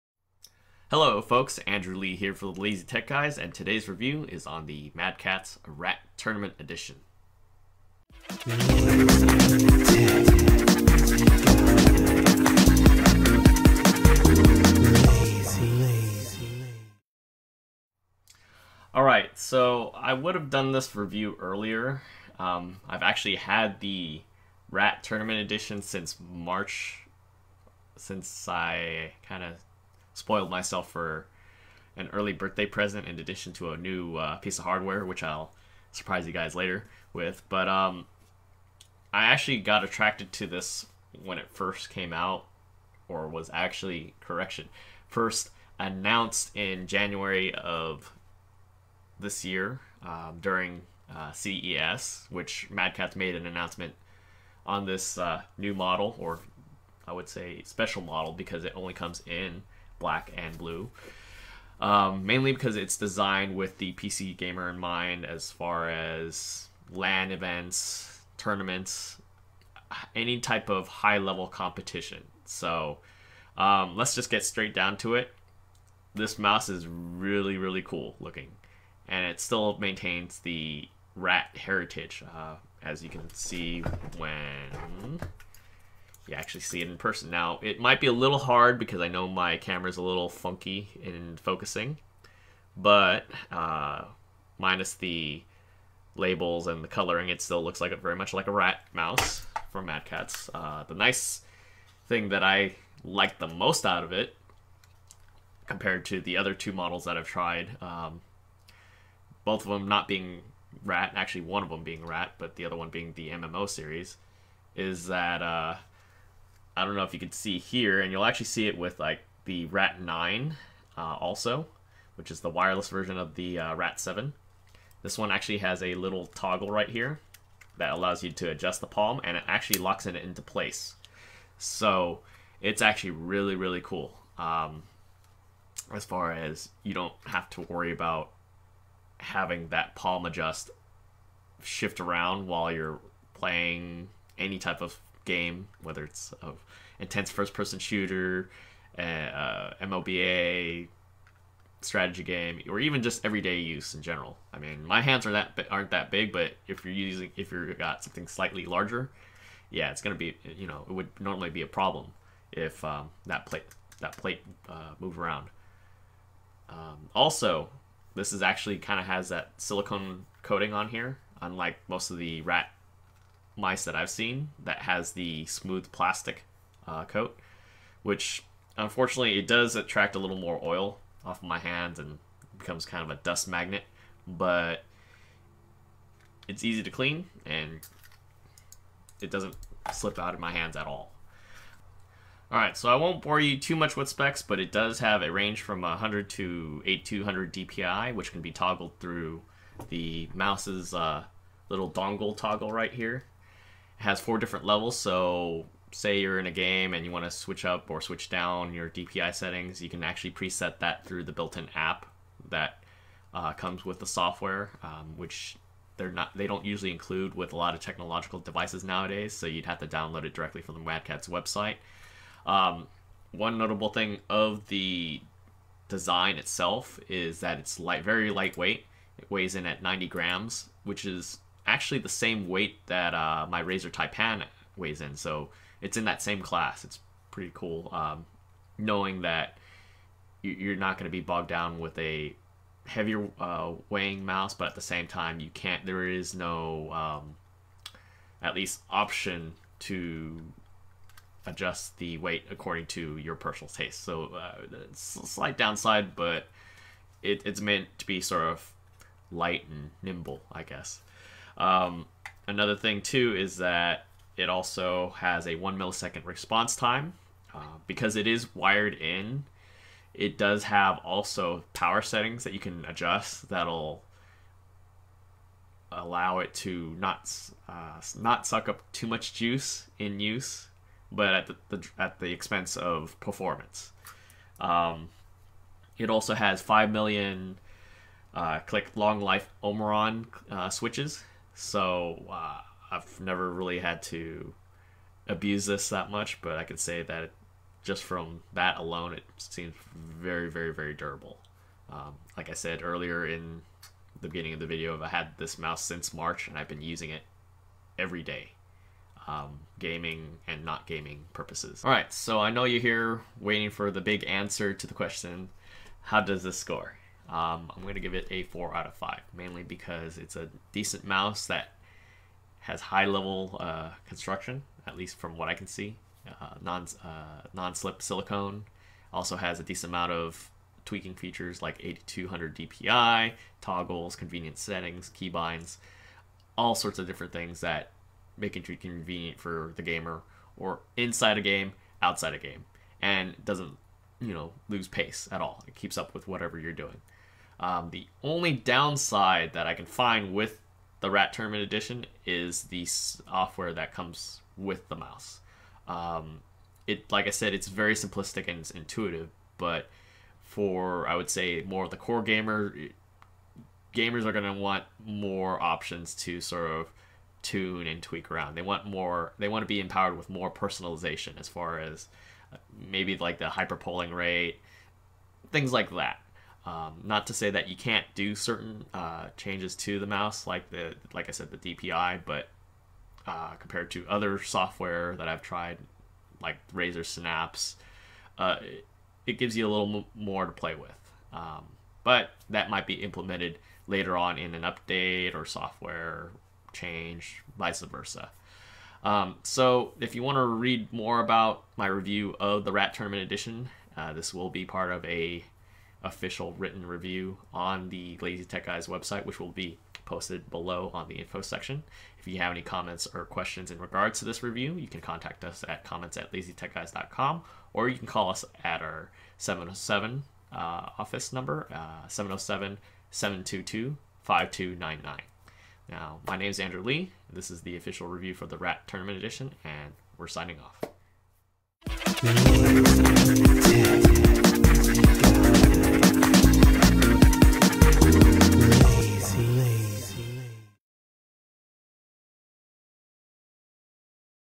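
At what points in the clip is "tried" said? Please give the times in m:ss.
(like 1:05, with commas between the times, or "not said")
1:47, 6:25.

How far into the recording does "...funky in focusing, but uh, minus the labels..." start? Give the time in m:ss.
1:30.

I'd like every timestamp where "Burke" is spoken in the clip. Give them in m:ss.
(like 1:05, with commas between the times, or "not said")
not said.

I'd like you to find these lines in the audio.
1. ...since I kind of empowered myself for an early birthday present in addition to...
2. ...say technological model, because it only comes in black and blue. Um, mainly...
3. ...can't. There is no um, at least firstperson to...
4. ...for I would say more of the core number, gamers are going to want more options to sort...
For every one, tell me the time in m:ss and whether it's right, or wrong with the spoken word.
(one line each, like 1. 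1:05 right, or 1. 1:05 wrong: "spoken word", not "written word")
1. 0:27 wrong: "spoiled", not "empowered"
2. 0:57 wrong: "special", not "technological"
3. 4:05 wrong: "option", not "firstperson"
4. 6:00 wrong: "gamer", not "number".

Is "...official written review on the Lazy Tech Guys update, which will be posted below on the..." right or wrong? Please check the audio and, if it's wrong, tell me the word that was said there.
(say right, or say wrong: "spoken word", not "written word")
wrong: "website", not "update".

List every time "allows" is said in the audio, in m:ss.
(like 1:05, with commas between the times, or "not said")
2:07, 4:35.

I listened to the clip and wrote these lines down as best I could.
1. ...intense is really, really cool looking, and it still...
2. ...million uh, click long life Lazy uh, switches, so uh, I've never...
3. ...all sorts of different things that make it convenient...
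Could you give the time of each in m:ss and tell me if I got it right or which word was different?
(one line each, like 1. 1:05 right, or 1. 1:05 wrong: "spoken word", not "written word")
1. 1:16 wrong: "mouse", not "intense"
2. 4:46 wrong: "Omron", not "Lazy"
3. 5:36 right.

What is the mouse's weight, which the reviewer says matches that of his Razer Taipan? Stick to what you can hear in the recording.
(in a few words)
90 grams.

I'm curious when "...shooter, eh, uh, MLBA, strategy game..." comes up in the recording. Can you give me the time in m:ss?
2:27.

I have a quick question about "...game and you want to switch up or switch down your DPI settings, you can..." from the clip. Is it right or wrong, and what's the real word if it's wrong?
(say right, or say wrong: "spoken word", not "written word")
right.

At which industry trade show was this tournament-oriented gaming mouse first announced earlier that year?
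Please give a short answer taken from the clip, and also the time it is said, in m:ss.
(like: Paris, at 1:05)
CES, at 0:51.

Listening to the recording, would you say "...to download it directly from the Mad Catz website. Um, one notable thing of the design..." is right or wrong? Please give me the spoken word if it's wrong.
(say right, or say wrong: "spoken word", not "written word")
right.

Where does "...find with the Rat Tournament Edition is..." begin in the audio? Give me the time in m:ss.
5:49.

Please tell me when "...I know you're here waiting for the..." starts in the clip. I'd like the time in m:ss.
5:12.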